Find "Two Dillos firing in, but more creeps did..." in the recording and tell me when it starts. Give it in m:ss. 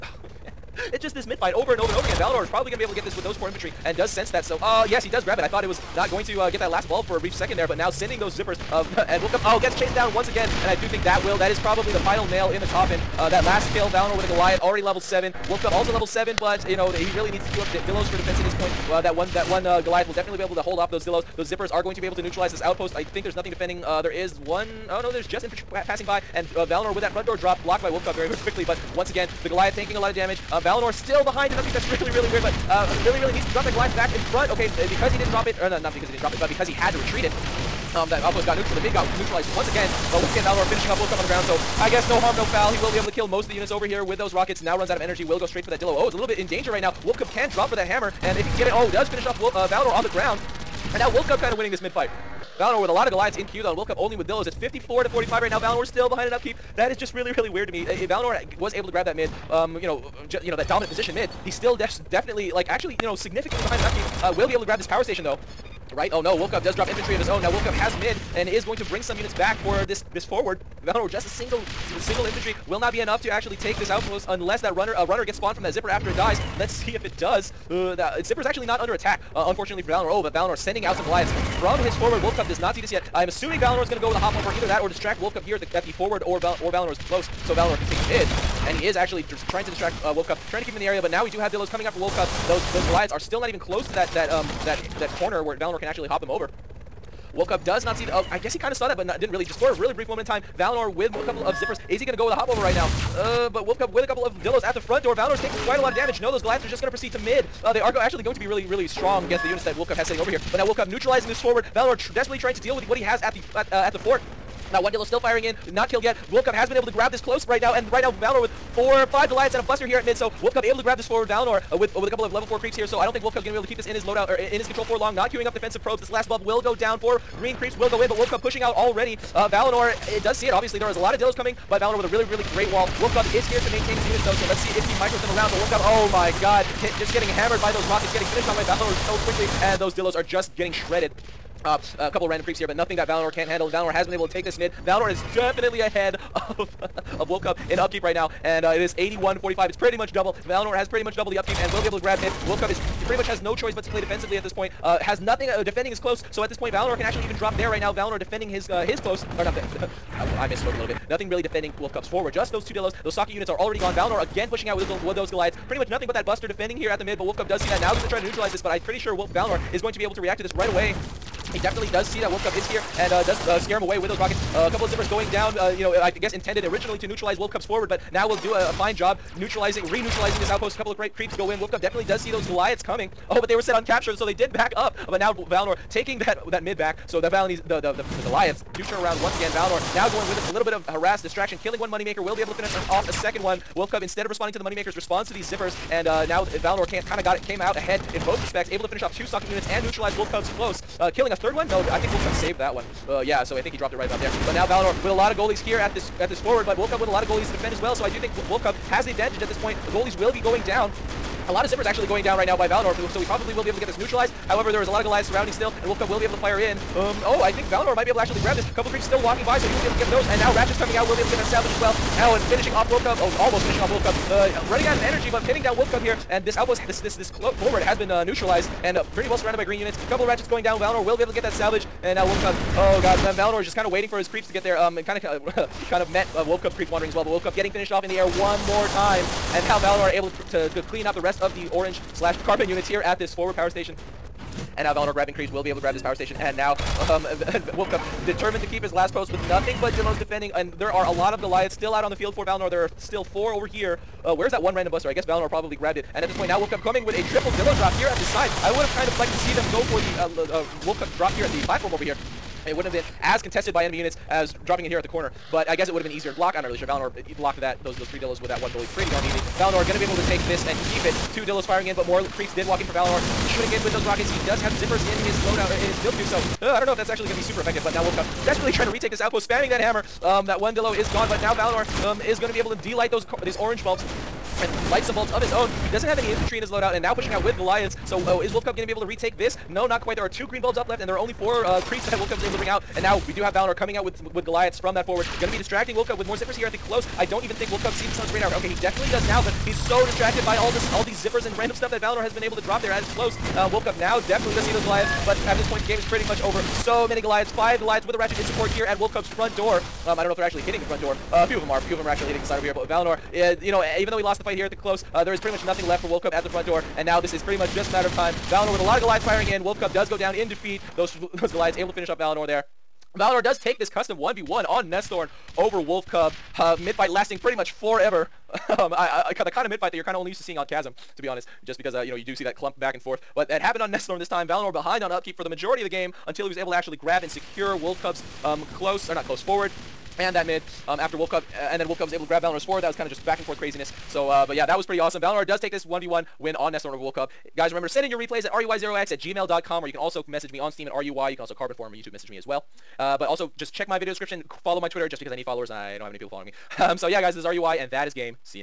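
4:31.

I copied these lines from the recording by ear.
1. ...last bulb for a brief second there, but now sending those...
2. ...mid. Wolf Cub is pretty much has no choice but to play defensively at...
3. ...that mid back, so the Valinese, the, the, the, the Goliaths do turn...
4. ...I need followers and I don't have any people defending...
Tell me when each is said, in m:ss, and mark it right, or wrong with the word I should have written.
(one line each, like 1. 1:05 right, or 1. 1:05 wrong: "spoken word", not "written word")
1. 0:06 right
2. 2:32 right
3. 3:06 right
4. 5:55 wrong: "following", not "defending".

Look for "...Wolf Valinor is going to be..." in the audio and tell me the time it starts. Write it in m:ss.
2:49.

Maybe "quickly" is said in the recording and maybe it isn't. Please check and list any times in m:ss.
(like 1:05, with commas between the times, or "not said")
0:28, 2:19.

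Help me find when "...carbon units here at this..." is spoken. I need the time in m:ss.
4:02.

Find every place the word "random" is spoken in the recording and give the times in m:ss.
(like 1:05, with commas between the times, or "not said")
2:22, 4:14, 5:01.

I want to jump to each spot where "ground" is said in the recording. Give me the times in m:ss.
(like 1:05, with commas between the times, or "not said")
0:41, 0:50.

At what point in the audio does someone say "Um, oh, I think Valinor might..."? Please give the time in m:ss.
3:36.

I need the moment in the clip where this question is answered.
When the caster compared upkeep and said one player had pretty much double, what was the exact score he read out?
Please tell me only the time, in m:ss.
2:28.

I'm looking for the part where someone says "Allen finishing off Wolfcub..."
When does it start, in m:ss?
3:42.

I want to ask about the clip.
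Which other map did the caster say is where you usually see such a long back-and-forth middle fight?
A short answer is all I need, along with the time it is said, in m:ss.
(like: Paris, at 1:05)
Chasm, at 5:30.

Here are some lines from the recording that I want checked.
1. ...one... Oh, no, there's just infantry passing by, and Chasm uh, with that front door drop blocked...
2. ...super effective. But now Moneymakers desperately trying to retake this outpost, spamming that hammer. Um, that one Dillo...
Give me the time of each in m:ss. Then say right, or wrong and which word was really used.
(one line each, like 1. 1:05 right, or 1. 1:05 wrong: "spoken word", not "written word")
1. 0:24 wrong: "Valinor", not "Chasm"
2. 4:37 wrong: "Wolfcub", not "Moneymakers".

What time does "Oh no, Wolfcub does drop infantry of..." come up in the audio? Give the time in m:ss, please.
1:06.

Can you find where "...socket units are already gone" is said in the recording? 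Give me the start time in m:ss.
2:43.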